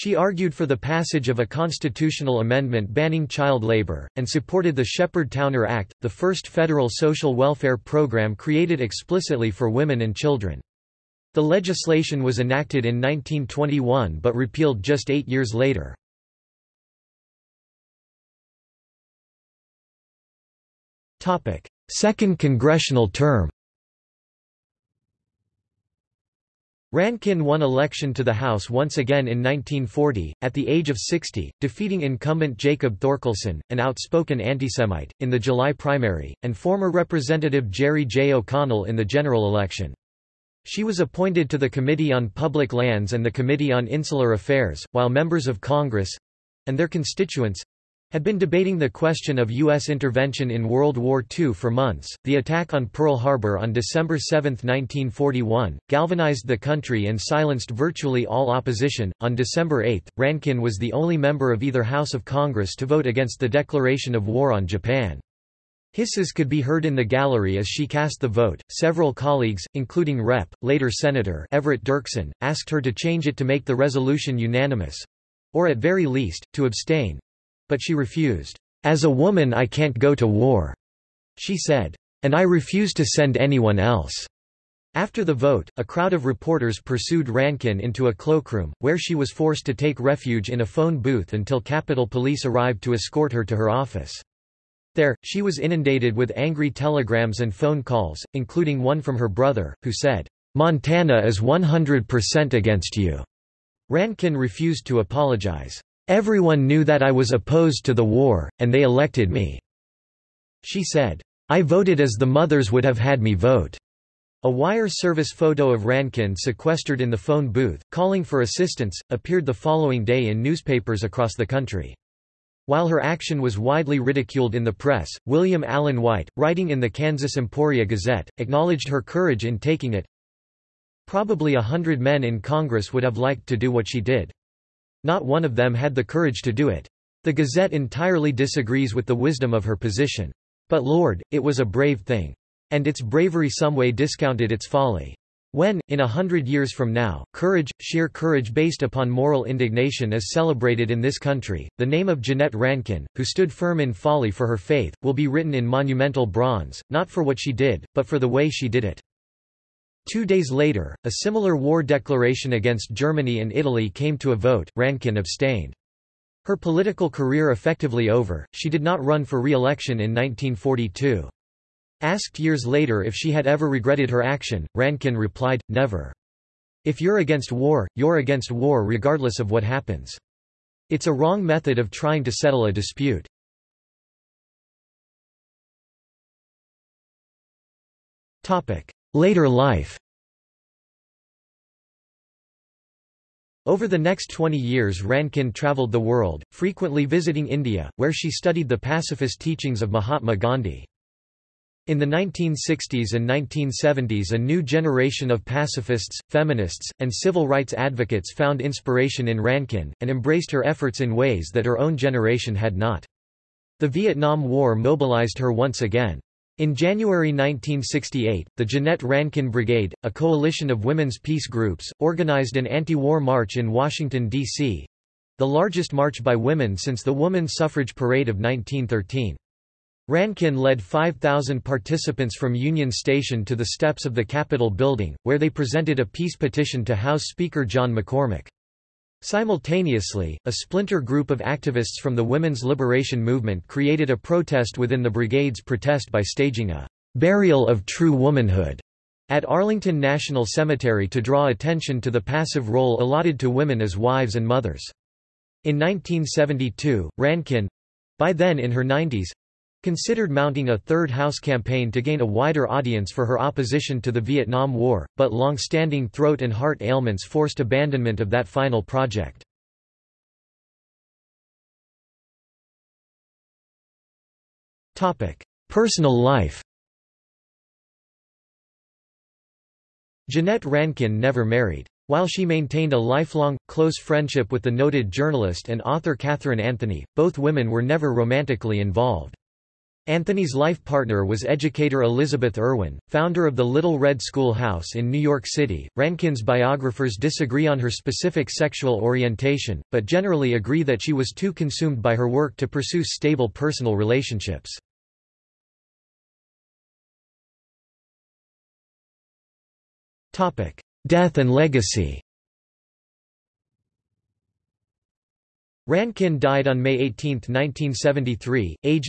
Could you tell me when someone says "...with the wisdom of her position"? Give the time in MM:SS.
02:18.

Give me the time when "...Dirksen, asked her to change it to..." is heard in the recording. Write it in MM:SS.
01:11.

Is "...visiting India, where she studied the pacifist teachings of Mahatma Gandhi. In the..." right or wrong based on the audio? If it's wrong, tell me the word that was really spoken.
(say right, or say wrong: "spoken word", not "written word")
right.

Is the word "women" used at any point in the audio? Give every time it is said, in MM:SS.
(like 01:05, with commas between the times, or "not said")
00:09, 03:40, 03:46, 04:02, 04:13, 04:47.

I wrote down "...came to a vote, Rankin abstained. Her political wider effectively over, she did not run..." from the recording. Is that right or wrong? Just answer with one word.
wrong.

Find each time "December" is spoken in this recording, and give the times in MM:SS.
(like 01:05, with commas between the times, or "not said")
00:53, 00:59.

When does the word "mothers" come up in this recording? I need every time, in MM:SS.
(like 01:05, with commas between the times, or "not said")
01:52, 04:14.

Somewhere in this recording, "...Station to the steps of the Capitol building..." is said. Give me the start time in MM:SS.
03:52.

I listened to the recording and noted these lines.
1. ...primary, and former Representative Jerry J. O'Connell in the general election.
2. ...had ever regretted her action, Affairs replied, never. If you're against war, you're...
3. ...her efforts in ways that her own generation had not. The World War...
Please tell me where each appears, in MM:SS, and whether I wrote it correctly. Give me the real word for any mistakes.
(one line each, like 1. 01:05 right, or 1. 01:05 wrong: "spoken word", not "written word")
1. 00:35 right
2. 02:53 wrong: "Rankin", not "Affairs"
3. 03:30 wrong: "Vietnam", not "World".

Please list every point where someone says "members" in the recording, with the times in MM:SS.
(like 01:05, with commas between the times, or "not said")
00:45, 01:01.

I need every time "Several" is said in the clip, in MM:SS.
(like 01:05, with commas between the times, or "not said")
01:08.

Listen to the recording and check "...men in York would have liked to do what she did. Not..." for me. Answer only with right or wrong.
wrong.